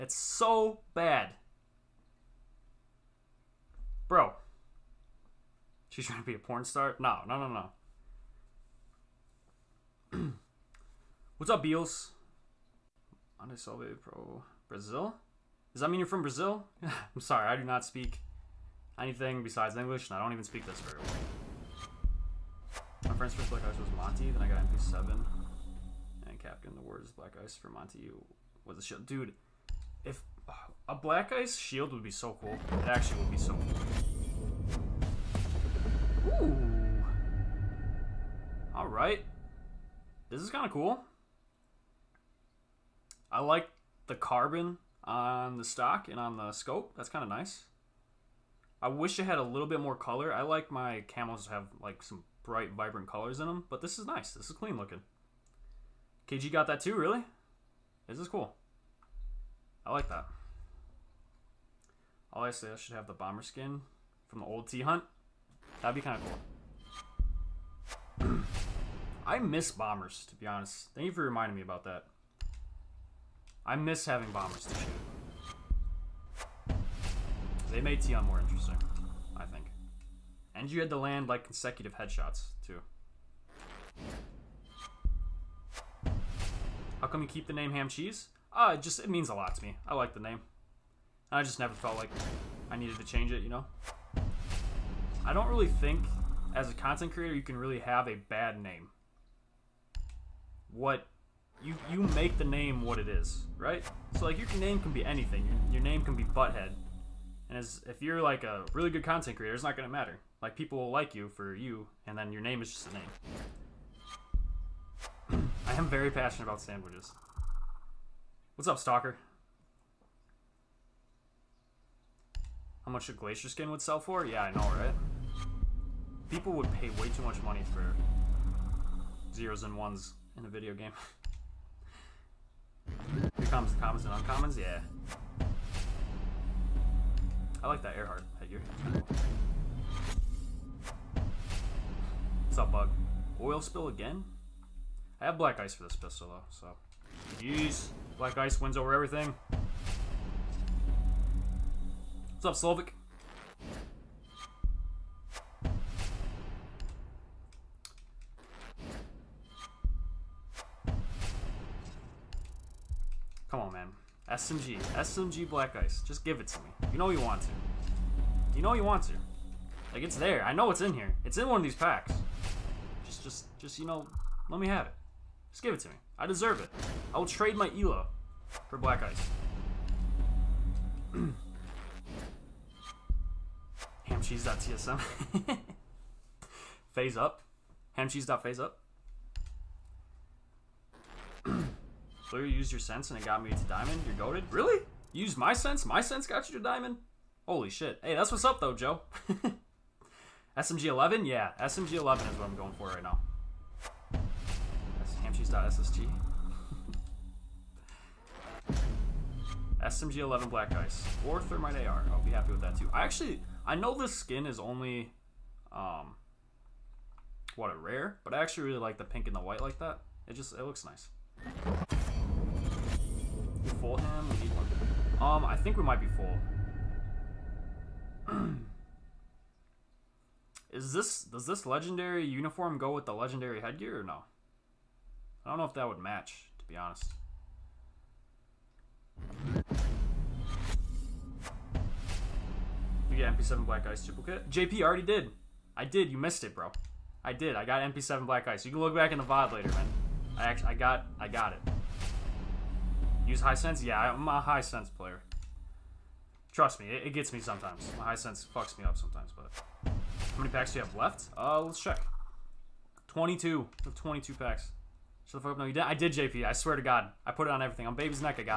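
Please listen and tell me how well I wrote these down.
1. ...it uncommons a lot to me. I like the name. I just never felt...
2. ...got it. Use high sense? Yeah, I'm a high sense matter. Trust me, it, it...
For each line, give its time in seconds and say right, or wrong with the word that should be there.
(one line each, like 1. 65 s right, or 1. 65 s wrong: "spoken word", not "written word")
1. 89 s wrong: "means", not "uncommons"
2. 251 s wrong: "player", not "matter".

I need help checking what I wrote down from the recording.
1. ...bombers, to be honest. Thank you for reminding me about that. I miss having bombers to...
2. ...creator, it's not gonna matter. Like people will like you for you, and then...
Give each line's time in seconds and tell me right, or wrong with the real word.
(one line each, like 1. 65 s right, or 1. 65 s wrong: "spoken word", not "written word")
1. 69 s right
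2. 109 s right.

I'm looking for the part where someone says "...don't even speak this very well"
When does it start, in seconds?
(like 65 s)
20 s.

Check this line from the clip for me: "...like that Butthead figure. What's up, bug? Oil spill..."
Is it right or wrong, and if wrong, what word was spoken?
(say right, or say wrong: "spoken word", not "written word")
wrong: "Earhart", not "Butthead".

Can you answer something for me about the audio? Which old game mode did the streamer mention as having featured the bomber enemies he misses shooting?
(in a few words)
T-Hunt.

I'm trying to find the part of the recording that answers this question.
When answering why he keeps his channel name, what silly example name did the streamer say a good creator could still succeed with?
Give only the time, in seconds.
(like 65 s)
106 s.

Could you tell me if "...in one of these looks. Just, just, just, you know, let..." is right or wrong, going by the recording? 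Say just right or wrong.
wrong.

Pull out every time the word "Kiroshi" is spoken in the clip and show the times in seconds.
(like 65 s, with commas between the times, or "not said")
not said.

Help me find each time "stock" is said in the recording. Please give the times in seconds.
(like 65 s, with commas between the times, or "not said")
45 s.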